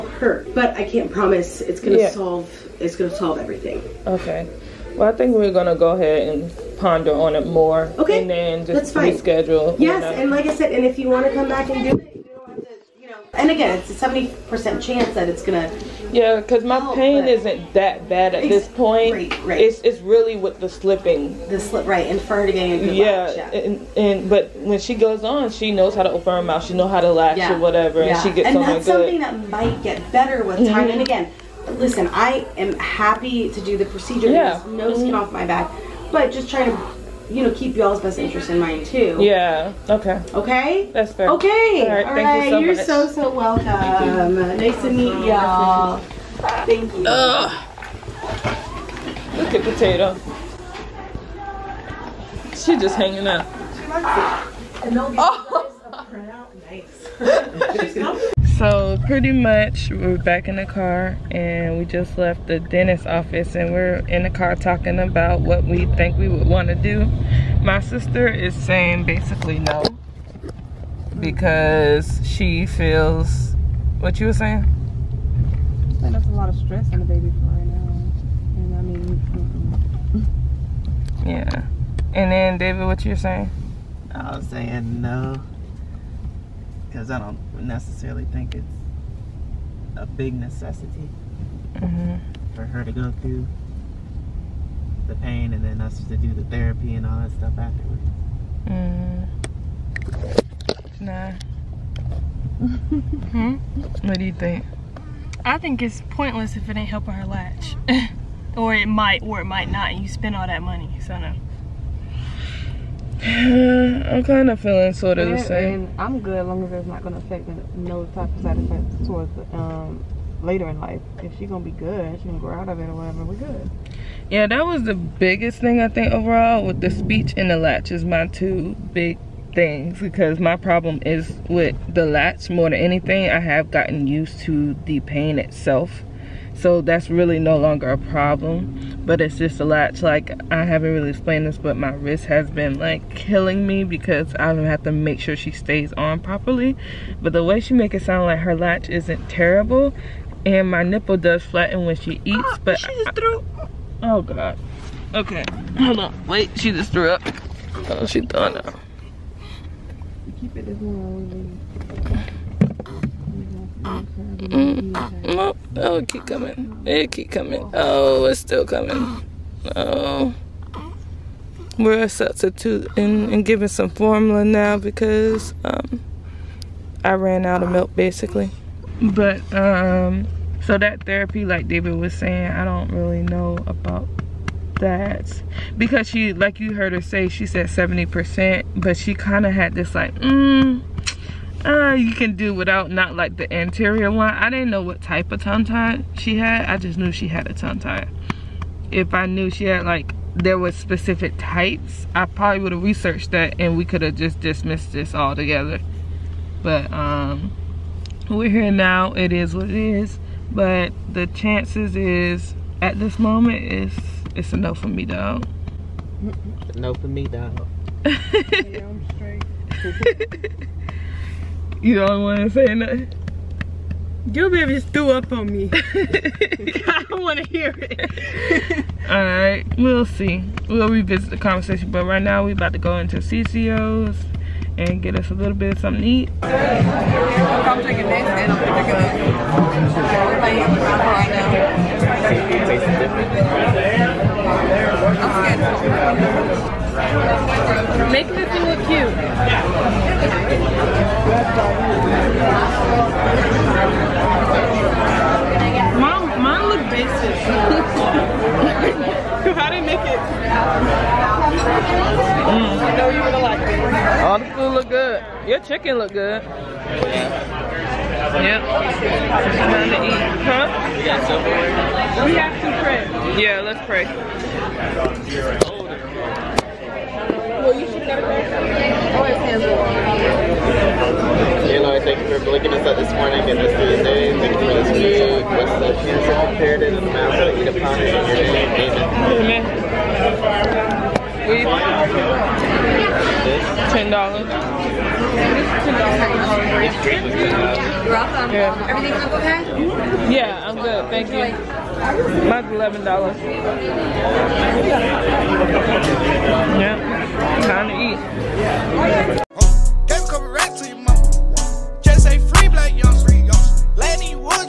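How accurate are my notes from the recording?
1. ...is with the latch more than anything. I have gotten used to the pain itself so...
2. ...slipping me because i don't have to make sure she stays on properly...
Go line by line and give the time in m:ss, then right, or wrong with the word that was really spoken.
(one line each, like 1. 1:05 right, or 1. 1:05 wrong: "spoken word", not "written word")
1. 2:11 right
2. 2:23 wrong: "killing", not "slipping".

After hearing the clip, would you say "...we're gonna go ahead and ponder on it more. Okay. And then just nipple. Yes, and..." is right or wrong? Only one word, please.
wrong.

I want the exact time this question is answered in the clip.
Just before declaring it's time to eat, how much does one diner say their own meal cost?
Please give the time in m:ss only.
5:02.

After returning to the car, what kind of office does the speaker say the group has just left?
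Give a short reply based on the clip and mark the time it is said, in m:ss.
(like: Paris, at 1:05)
dentist office, at 1:02.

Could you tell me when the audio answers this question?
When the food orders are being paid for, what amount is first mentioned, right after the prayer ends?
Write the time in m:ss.
4:53.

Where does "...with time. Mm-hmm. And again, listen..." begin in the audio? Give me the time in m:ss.
0:30.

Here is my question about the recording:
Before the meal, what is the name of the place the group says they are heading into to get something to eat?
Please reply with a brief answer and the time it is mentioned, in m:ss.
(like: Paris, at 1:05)
CCO's, at 3:53.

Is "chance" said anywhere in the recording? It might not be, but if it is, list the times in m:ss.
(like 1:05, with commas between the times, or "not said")
0:14, 3:31.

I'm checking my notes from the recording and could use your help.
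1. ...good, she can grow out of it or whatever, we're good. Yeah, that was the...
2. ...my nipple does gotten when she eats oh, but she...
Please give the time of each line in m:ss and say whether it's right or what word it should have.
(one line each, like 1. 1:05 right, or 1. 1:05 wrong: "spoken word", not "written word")
1. 2:01 right
2. 2:30 wrong: "flatten", not "gotten".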